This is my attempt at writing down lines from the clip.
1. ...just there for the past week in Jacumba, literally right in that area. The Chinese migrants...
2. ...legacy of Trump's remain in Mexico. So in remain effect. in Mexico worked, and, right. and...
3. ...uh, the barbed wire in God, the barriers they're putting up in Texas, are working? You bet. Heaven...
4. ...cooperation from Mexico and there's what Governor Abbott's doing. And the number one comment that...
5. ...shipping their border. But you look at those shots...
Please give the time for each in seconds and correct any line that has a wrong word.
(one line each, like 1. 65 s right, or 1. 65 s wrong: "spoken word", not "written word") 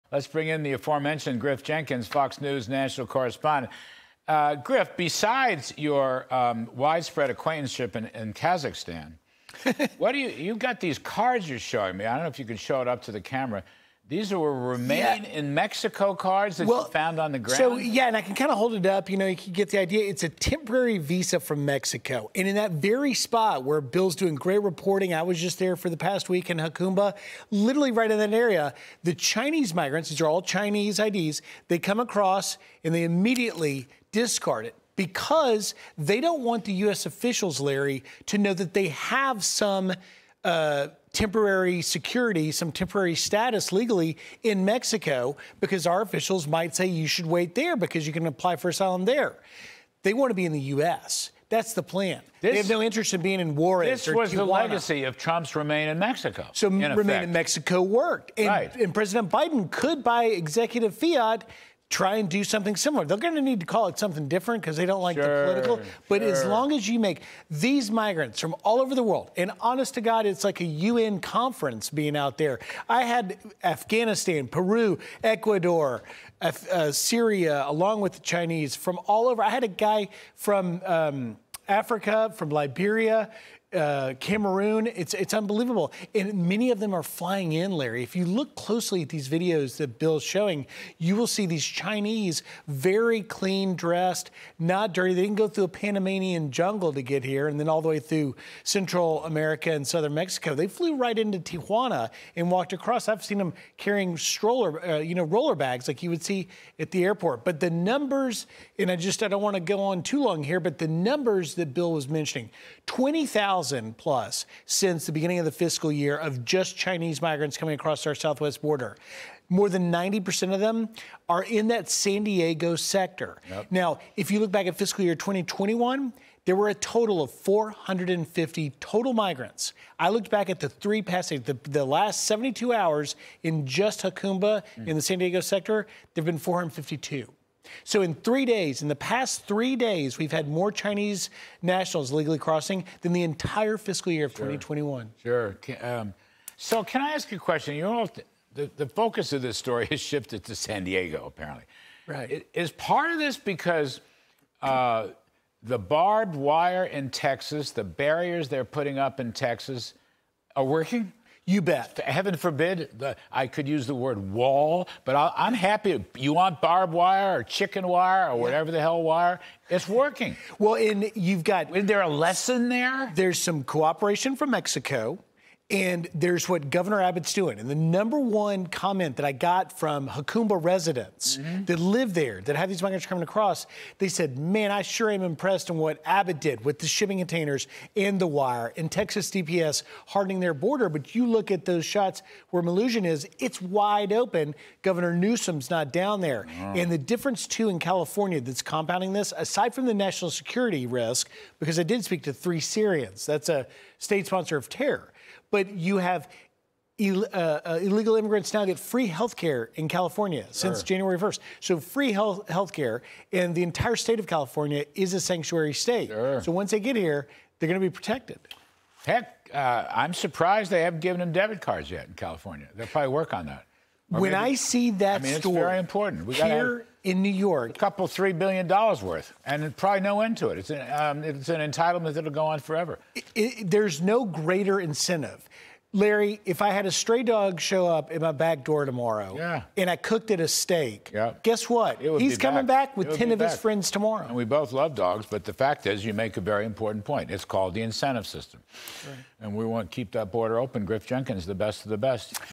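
1. 25 s right
2. 54 s right
3. 154 s wrong: "Texas", not "God"
4. 173 s right
5. 190 s wrong: "hardening", not "shipping".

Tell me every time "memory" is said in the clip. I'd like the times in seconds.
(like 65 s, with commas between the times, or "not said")
not said.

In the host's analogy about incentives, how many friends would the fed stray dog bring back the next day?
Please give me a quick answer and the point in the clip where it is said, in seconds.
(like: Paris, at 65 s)
10, at 243 s.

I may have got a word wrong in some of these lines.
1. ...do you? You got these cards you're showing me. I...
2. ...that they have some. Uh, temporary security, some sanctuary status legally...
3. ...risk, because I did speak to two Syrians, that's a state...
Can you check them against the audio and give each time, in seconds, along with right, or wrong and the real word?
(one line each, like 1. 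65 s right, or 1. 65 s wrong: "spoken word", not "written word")
1. 10 s right
2. 38 s wrong: "temporary", not "sanctuary"
3. 200 s wrong: "three", not "two".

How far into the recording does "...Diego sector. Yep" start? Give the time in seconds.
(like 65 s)
122 s.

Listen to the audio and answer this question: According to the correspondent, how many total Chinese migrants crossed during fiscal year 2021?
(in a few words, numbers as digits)
450.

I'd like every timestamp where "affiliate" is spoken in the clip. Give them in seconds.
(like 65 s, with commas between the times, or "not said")
not said.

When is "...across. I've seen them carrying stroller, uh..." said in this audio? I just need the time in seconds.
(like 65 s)
102 s.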